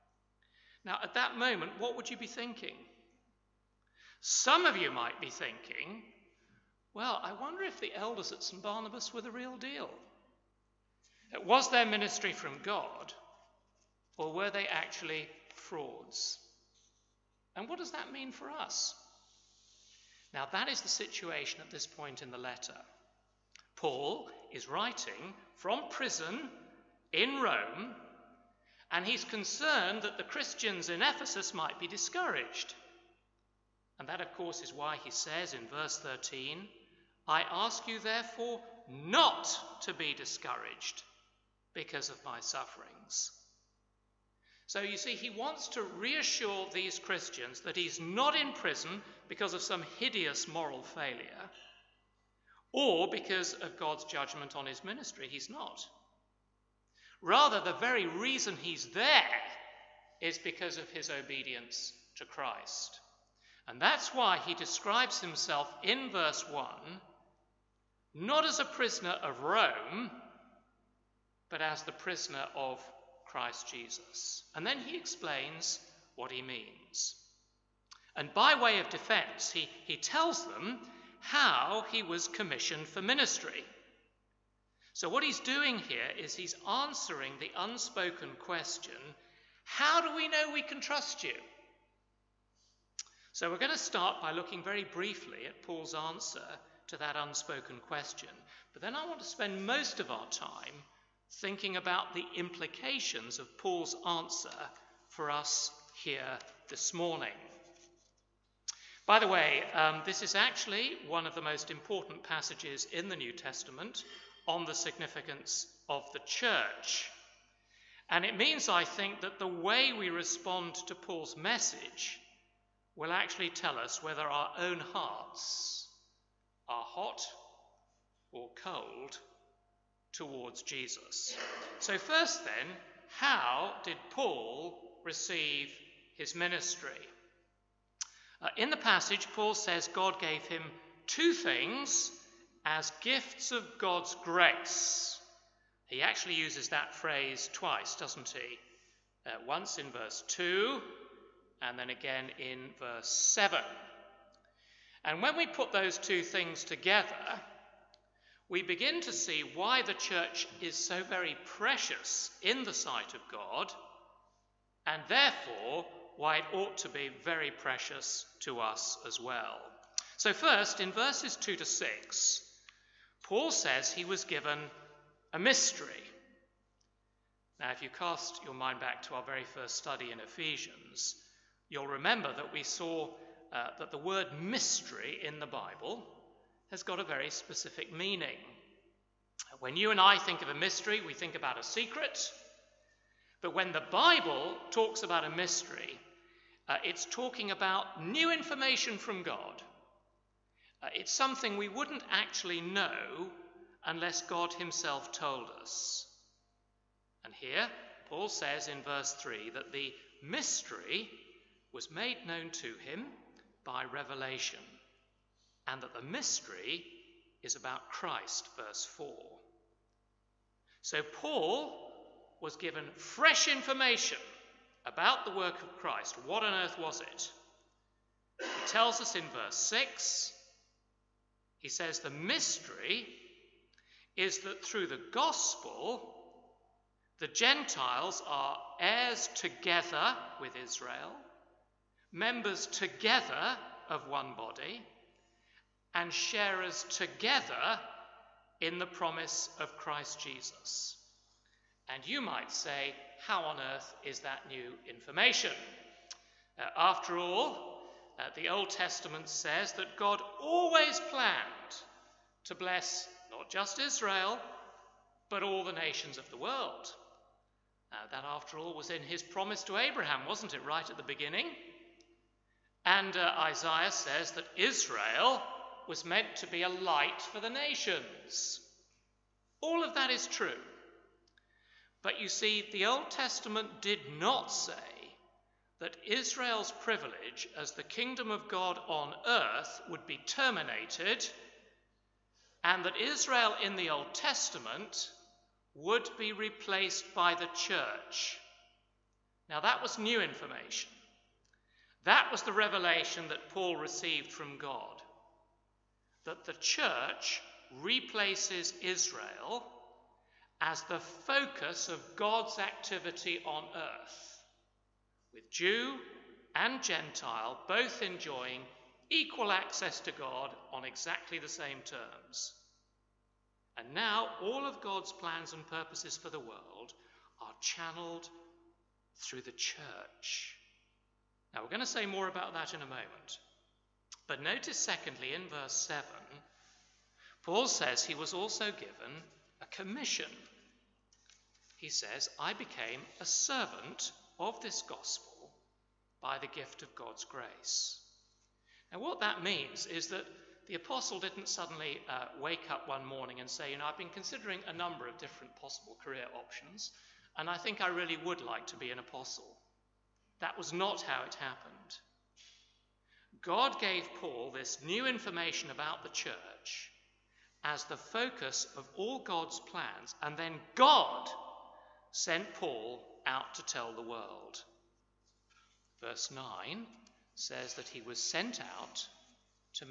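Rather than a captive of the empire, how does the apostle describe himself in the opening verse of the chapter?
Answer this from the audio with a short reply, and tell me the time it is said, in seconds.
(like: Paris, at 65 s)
the prisoner of Christ Jesus, at 71 s.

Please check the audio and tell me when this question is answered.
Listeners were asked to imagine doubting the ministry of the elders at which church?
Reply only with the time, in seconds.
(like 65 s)
8 s.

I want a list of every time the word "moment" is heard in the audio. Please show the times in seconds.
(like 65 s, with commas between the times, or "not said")
1 s, 332 s.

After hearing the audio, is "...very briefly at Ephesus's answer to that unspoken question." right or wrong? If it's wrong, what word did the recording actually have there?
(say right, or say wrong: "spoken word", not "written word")
wrong: "Paul", not "Ephesus".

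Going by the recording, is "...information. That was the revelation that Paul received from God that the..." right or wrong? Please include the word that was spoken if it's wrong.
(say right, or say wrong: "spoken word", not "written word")
right.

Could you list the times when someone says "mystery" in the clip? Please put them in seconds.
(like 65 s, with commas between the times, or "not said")
175 s, 184 s, 190 s, 195 s, 210 s, 216 s, 232 s.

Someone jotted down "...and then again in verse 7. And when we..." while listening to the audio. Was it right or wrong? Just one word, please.
right.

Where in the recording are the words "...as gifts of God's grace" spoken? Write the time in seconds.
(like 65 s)
142 s.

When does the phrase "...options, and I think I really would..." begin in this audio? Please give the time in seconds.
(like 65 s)
356 s.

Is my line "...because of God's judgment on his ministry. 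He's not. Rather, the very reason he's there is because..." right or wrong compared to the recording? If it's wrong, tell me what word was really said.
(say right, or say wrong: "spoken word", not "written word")
right.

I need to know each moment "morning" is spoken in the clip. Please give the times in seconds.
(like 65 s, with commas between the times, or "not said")
106 s, 353 s.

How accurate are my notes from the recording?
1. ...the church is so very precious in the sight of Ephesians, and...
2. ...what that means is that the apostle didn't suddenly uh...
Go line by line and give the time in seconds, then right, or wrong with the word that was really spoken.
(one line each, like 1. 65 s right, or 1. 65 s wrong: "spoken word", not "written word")
1. 159 s wrong: "God", not "Ephesians"
2. 348 s right.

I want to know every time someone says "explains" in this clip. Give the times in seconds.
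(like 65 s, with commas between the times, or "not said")
74 s.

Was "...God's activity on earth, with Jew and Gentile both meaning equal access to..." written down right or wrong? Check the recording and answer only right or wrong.
wrong.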